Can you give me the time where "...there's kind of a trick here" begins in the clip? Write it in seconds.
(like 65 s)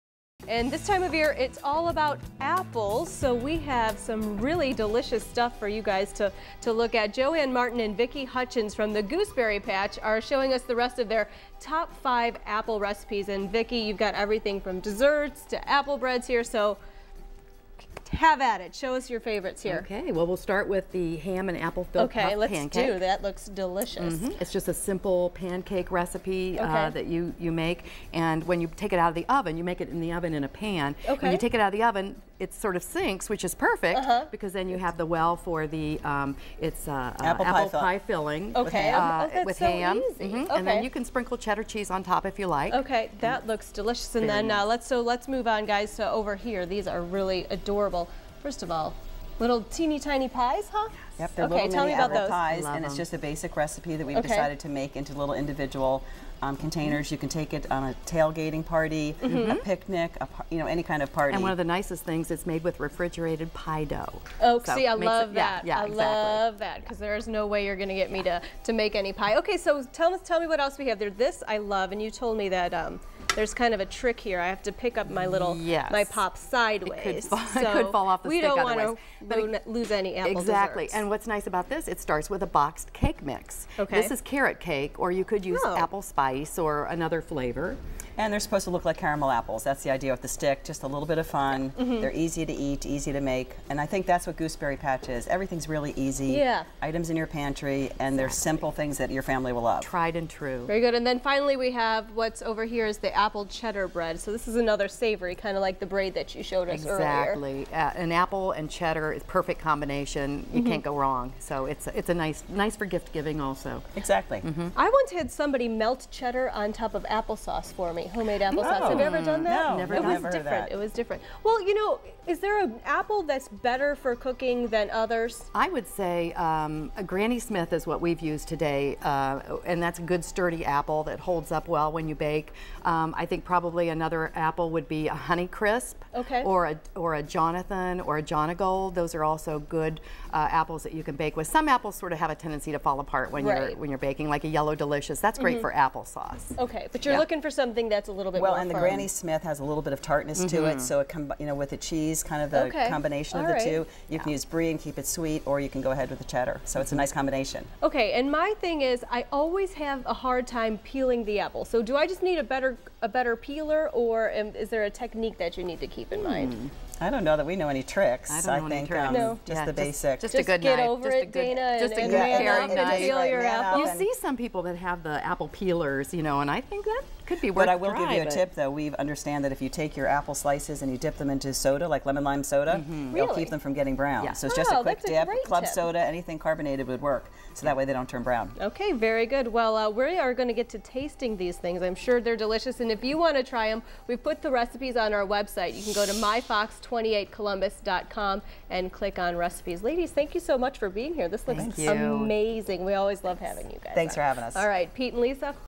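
73 s.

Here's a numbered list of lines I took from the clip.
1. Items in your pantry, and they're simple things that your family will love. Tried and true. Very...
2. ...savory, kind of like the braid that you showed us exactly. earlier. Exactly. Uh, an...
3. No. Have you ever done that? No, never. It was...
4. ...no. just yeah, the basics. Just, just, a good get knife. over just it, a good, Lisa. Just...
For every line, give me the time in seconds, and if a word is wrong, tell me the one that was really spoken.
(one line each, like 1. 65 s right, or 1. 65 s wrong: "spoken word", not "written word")
1. 96 s right
2. 104 s right
3. 118 s right
4. 169 s wrong: "Dana", not "Lisa".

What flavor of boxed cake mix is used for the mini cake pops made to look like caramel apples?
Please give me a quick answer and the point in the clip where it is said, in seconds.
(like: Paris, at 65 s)
carrot cake, at 84 s.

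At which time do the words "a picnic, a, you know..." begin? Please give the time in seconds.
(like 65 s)
59 s.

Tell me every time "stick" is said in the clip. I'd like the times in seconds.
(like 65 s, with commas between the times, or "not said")
78 s, 90 s.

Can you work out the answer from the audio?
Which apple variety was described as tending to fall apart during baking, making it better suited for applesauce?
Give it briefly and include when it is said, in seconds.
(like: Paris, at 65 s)
Yellow Delicious, at 144 s.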